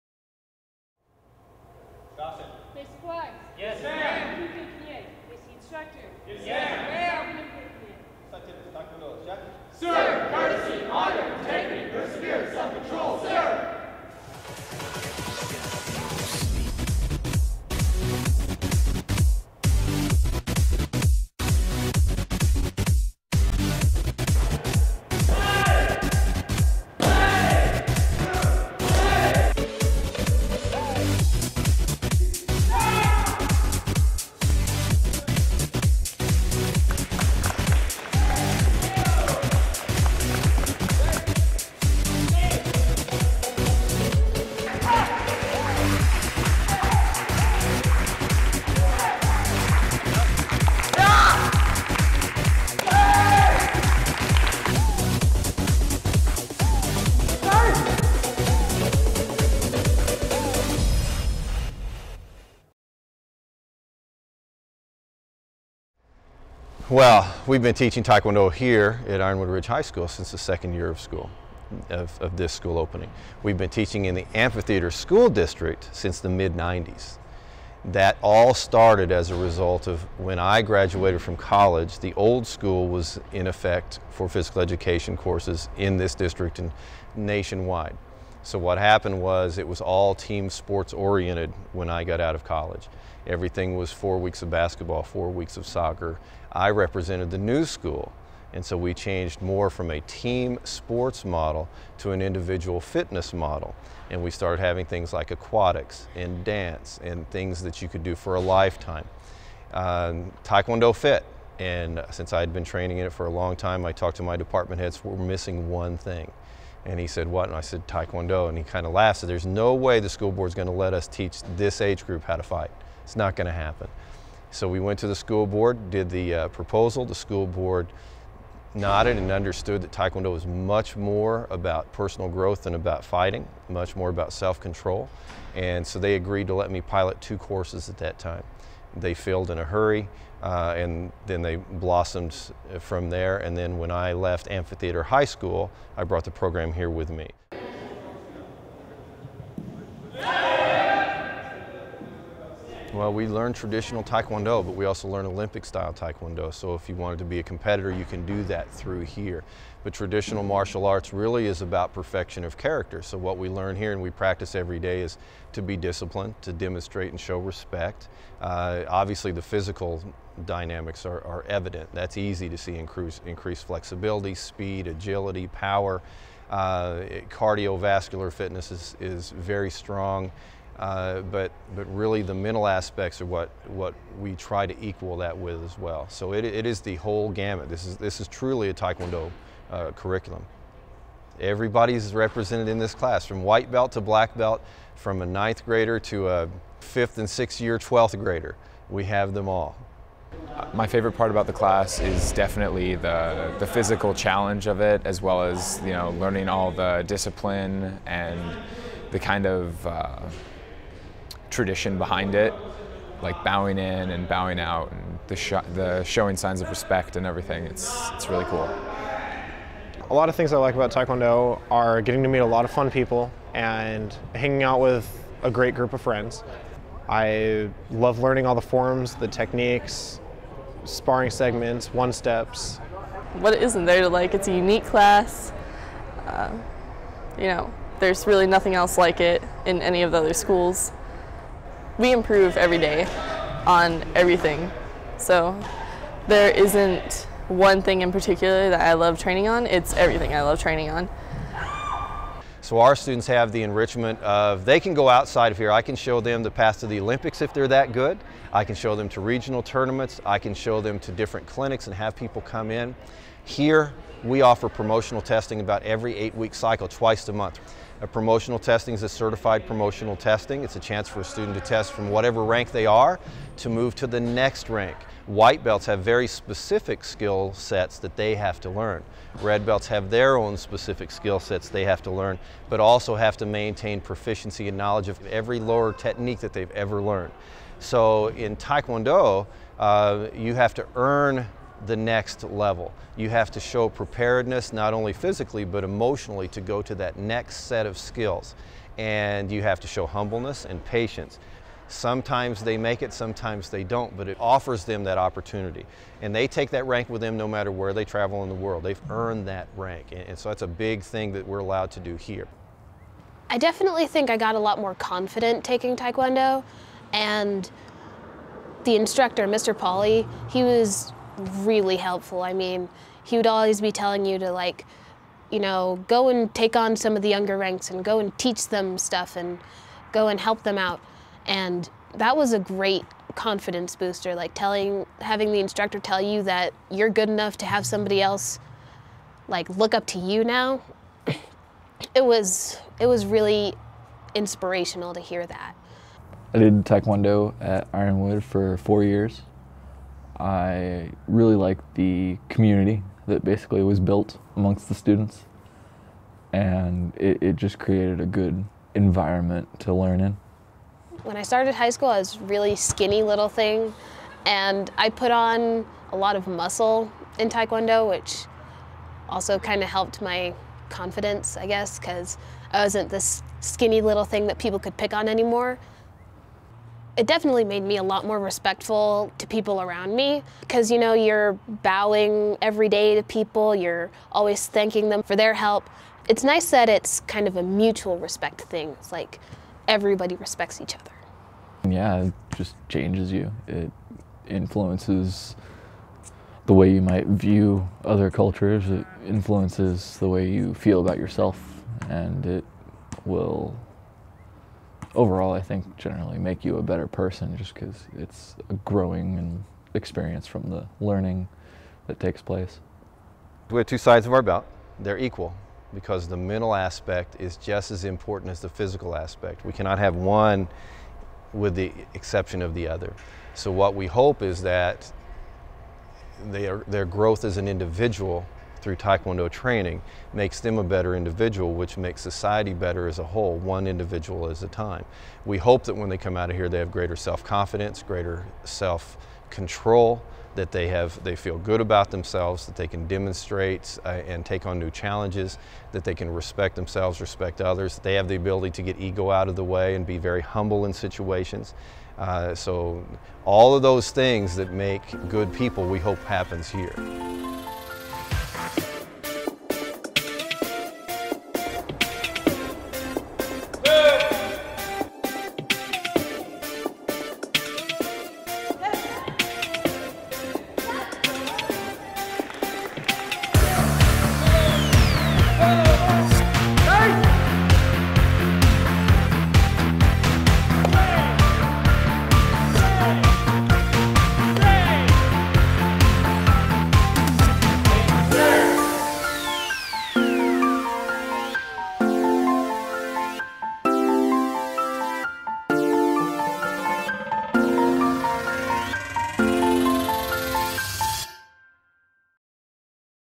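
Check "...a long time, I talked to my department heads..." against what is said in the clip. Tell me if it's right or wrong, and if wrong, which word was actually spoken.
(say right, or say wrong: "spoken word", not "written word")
right.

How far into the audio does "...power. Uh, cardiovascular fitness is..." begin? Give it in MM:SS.
02:55.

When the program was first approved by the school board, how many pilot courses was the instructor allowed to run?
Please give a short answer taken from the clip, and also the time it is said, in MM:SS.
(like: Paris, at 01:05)
2, at 02:17.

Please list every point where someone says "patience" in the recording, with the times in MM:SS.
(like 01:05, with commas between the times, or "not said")
05:00.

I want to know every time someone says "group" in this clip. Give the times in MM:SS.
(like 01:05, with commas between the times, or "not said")
02:02, 03:45.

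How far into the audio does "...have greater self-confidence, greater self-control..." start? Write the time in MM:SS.
07:16.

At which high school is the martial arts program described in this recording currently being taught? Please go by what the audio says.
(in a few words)
Ironwood Ridge High School.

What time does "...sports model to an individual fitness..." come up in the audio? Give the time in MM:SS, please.
01:40.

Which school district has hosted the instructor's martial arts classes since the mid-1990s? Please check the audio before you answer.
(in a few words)
Amphitheater School District.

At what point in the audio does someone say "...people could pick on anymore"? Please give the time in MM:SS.
06:14.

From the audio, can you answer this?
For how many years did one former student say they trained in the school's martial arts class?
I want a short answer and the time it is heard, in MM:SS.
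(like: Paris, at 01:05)
4, at 05:48.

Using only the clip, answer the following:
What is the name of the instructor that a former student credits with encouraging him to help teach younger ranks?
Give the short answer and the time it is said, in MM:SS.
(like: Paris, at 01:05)
Mr. Polly, at 05:19.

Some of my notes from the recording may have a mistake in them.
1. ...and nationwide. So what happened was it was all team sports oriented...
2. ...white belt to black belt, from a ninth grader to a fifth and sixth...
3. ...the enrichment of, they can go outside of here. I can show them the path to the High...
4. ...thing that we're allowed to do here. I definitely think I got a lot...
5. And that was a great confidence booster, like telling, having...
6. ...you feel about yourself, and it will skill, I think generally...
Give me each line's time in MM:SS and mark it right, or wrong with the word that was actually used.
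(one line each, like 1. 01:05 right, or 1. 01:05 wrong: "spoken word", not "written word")
1. 01:26 right
2. 03:13 right
3. 04:13 wrong: "Olympics", not "High"
4. 05:11 right
5. 05:31 right
6. 06:40 wrong: "overall", not "skill".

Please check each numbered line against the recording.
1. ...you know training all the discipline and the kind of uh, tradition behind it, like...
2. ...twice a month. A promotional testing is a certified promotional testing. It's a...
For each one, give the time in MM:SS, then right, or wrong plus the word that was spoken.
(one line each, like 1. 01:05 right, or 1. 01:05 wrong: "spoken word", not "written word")
1. 03:25 wrong: "learning", not "training"
2. 04:26 right.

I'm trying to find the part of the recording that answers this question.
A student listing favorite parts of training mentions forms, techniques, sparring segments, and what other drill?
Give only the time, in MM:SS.
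03:51.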